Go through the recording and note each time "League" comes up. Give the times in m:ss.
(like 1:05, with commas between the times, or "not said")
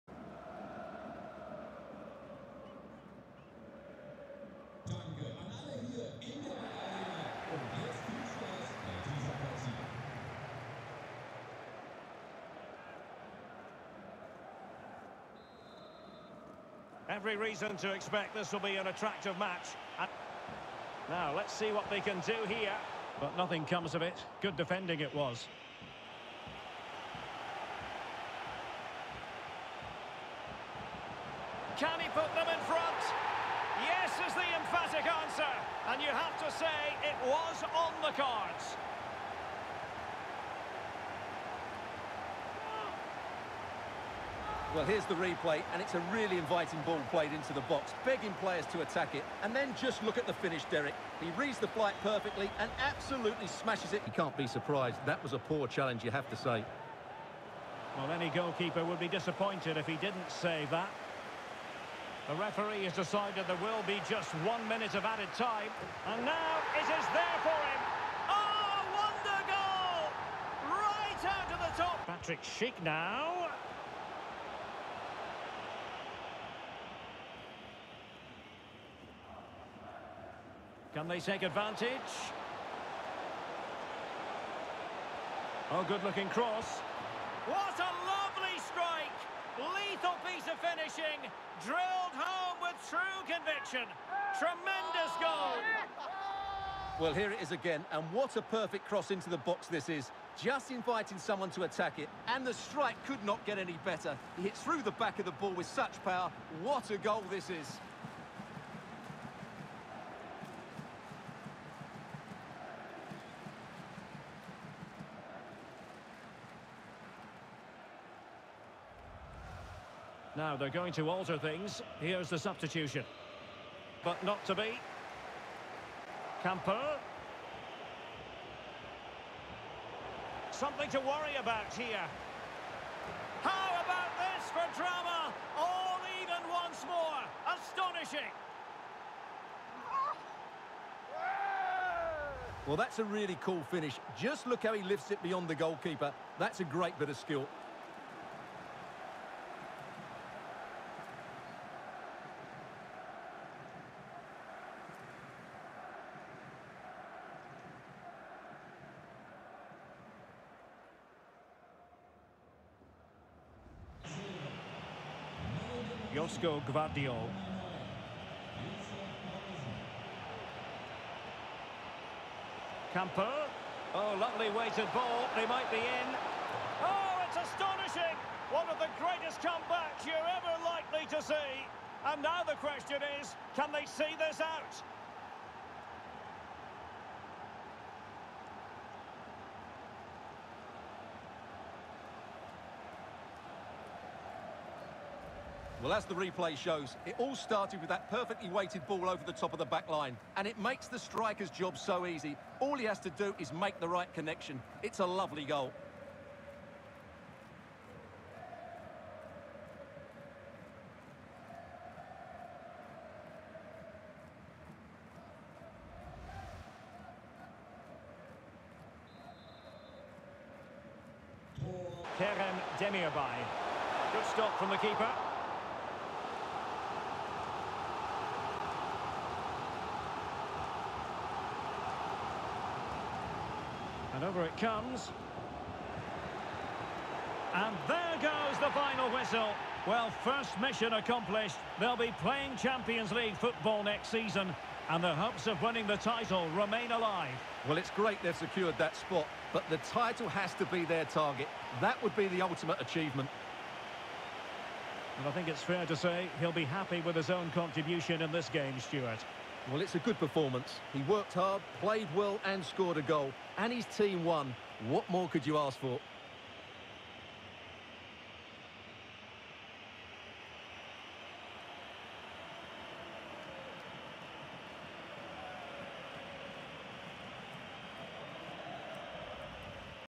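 4:03.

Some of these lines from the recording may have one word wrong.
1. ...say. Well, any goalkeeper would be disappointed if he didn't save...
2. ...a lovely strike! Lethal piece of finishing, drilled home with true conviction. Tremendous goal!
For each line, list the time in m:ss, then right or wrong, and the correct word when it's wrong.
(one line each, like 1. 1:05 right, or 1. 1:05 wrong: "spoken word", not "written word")
1. 0:56 right
2. 1:27 right.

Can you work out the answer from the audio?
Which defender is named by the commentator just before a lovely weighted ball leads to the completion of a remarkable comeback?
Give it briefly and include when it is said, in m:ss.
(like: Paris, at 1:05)
Josko Gvardiol, at 2:46.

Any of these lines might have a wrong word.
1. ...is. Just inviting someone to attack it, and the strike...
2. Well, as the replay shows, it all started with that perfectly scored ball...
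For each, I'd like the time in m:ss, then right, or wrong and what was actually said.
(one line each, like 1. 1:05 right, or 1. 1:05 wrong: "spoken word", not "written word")
1. 1:39 right
2. 3:15 wrong: "weighted", not "scored".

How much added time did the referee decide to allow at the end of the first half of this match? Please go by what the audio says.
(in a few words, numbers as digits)
1 minute.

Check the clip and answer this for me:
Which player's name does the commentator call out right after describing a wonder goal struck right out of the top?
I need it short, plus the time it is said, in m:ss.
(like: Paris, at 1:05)
Patrick Schick, at 1:12.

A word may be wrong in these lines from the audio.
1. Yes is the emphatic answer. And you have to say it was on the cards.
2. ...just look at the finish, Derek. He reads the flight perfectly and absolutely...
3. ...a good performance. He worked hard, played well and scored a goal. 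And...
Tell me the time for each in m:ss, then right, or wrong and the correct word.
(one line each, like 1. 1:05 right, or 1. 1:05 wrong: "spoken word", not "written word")
1. 0:33 right
2. 0:49 right
3. 4:19 right.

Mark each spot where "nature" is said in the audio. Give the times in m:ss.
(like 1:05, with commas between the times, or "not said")
not said.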